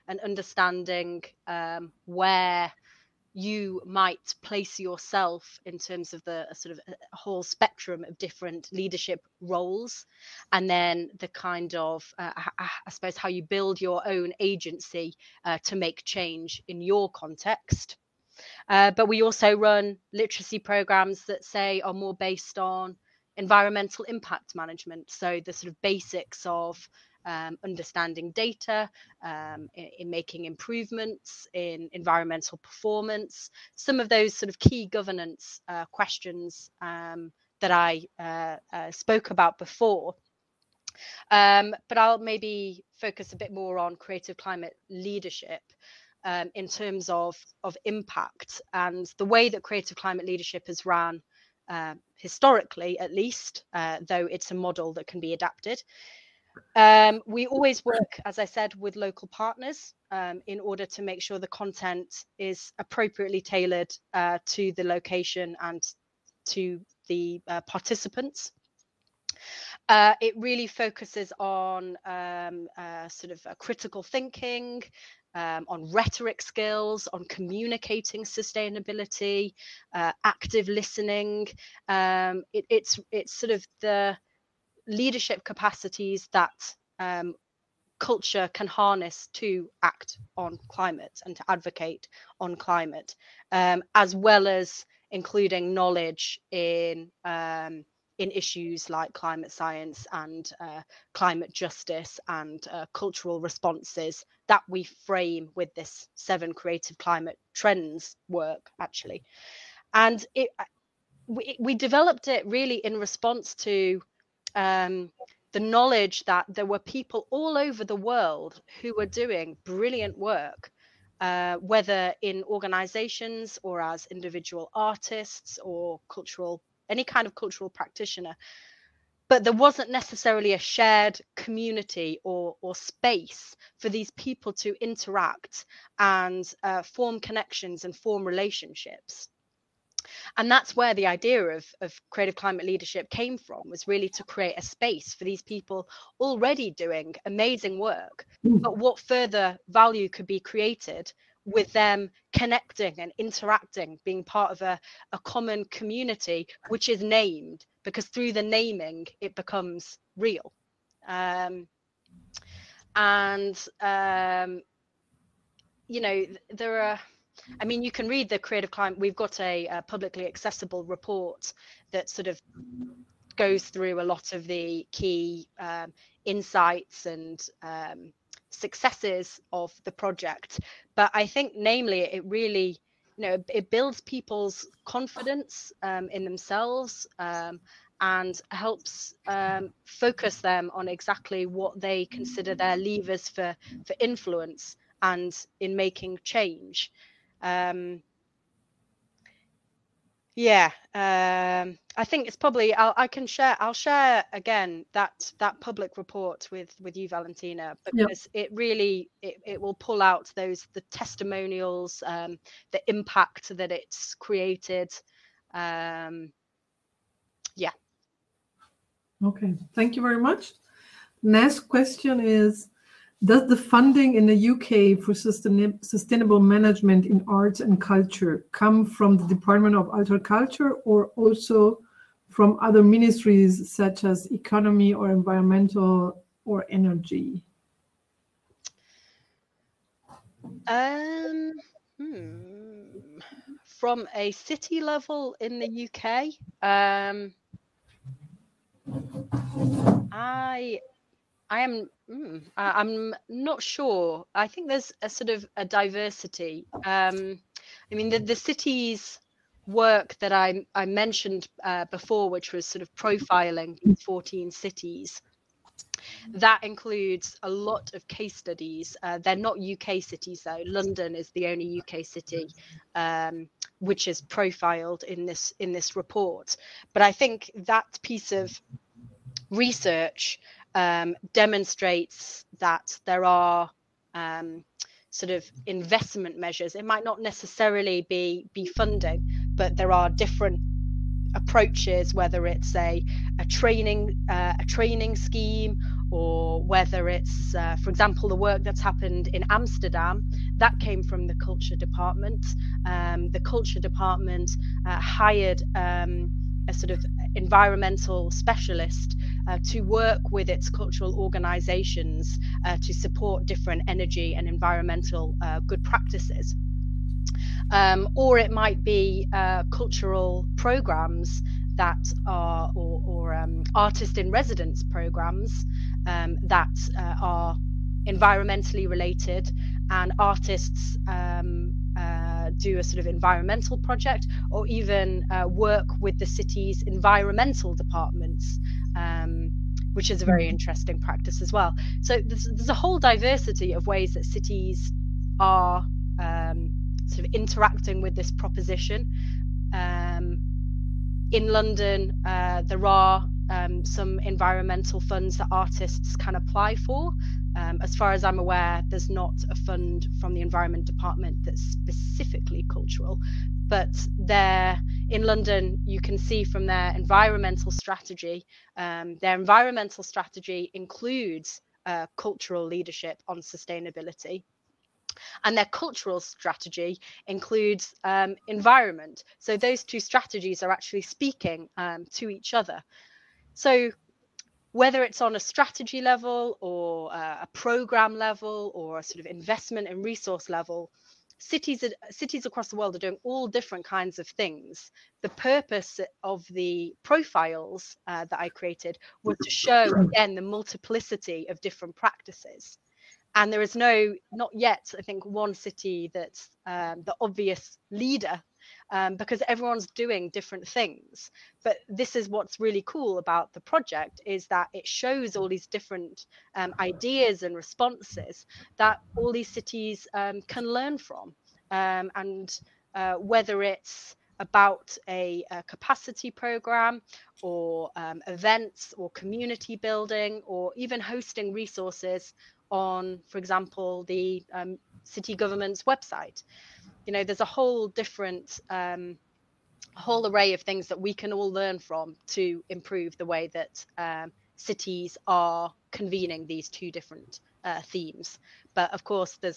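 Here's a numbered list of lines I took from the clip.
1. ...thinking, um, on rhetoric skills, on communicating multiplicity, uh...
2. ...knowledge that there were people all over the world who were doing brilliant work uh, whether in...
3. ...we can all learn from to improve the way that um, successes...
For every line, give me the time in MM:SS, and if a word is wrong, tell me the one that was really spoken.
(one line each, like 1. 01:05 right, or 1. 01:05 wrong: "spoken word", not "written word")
1. 01:14 wrong: "sustainability", not "multiplicity"
2. 01:55 right
3. 07:20 wrong: "cities", not "successes".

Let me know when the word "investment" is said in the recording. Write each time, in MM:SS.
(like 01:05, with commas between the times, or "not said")
04:45, 06:29.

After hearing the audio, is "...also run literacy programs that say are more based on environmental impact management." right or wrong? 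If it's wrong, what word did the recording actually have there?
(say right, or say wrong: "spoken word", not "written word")
right.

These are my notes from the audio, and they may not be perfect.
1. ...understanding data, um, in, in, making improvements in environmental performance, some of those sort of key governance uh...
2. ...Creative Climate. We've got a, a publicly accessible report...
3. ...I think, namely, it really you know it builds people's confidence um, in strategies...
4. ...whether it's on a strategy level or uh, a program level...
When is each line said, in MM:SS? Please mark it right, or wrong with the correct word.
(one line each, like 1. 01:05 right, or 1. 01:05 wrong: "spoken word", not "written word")
1. 00:27 right
2. 02:48 right
3. 03:01 wrong: "themselves", not "strategies"
4. 06:24 right.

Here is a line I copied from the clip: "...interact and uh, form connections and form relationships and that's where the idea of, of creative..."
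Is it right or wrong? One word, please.
right.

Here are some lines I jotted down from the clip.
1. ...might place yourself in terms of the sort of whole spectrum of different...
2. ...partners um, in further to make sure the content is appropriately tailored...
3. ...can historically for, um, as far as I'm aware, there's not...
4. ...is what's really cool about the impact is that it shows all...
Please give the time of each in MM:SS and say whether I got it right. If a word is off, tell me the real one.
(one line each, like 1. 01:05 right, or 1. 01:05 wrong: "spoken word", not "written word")
1. 00:03 right
2. 00:59 wrong: "order", not "further"
3. 05:56 wrong: "apply", not "historically"
4. 06:52 wrong: "project", not "impact".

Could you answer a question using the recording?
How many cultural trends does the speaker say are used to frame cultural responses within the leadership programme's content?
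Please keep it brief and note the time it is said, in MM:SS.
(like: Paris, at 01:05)
7, at 01:46.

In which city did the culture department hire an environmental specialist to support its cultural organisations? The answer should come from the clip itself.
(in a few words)
Amsterdam.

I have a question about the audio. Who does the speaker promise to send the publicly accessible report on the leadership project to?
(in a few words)
Valentina.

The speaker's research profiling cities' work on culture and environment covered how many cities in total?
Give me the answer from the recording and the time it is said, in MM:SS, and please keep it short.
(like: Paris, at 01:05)
14, at 04:23.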